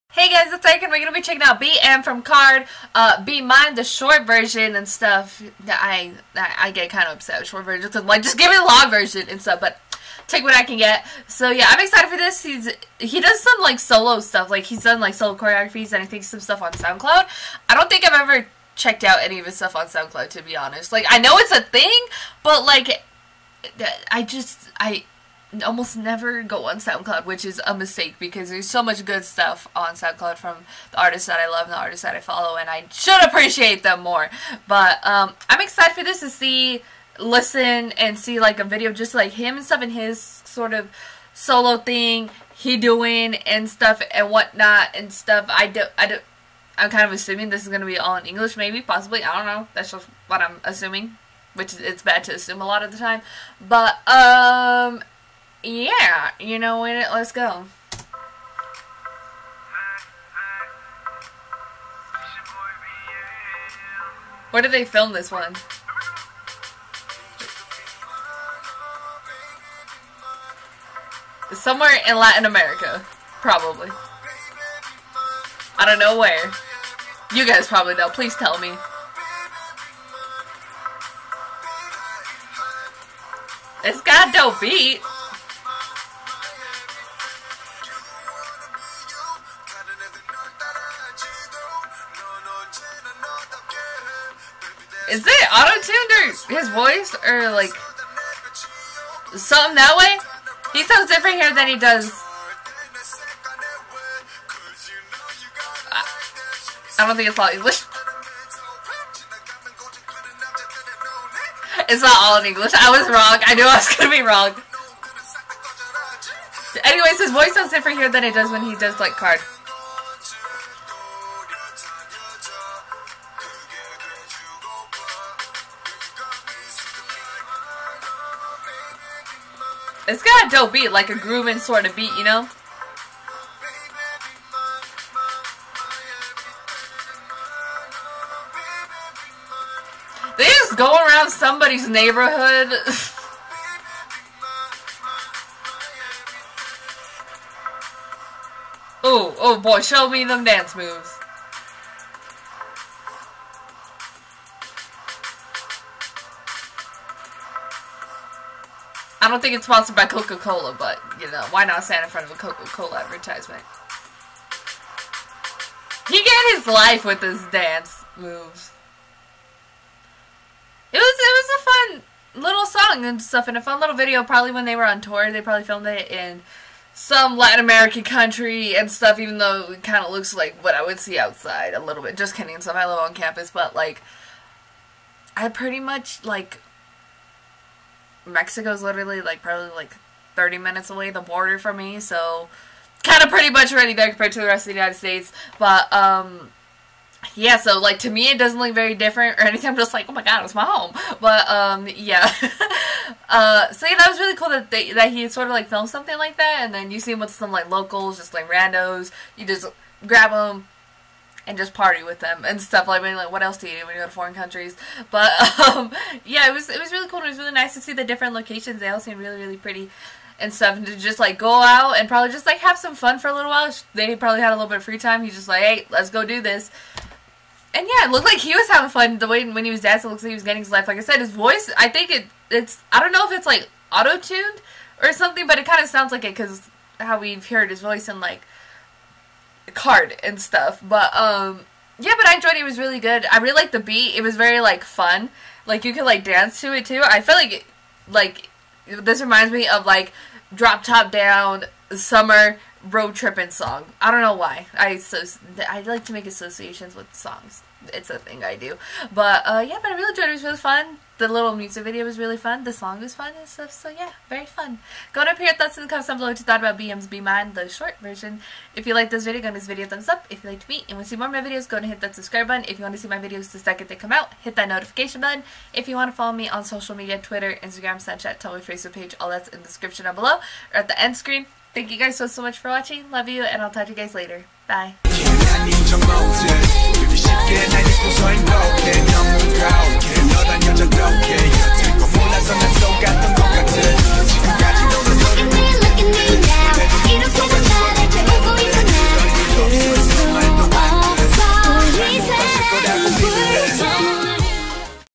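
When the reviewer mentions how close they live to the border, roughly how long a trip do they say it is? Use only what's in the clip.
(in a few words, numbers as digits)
30 minutes.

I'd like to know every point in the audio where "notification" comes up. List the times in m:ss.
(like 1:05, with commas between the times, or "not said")
4:34.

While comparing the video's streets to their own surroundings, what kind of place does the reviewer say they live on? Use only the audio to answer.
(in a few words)
campus.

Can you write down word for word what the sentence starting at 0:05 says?
I I, I get kind of upset with short versions.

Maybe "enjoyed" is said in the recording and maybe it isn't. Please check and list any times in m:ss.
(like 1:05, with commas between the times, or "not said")
4:02, 4:20.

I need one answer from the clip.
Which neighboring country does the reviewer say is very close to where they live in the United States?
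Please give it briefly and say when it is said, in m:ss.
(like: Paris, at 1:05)
Mexico, at 3:08.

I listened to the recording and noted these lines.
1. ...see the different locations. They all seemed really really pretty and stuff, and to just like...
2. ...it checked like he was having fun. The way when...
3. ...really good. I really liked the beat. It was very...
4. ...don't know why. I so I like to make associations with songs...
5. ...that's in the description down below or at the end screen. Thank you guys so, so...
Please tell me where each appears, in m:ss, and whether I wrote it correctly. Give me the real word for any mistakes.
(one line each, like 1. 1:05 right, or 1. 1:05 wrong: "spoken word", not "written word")
1. 3:37 right
2. 3:48 wrong: "looked", not "checked"
3. 4:02 right
4. 4:14 right
5. 4:39 right.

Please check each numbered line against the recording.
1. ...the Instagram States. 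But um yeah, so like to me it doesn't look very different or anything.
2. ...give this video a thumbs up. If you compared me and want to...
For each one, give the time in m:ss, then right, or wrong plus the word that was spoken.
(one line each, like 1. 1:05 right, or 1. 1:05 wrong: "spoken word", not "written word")
1. 3:14 wrong: "United", not "Instagram"
2. 4:29 wrong: "liked", not "compared".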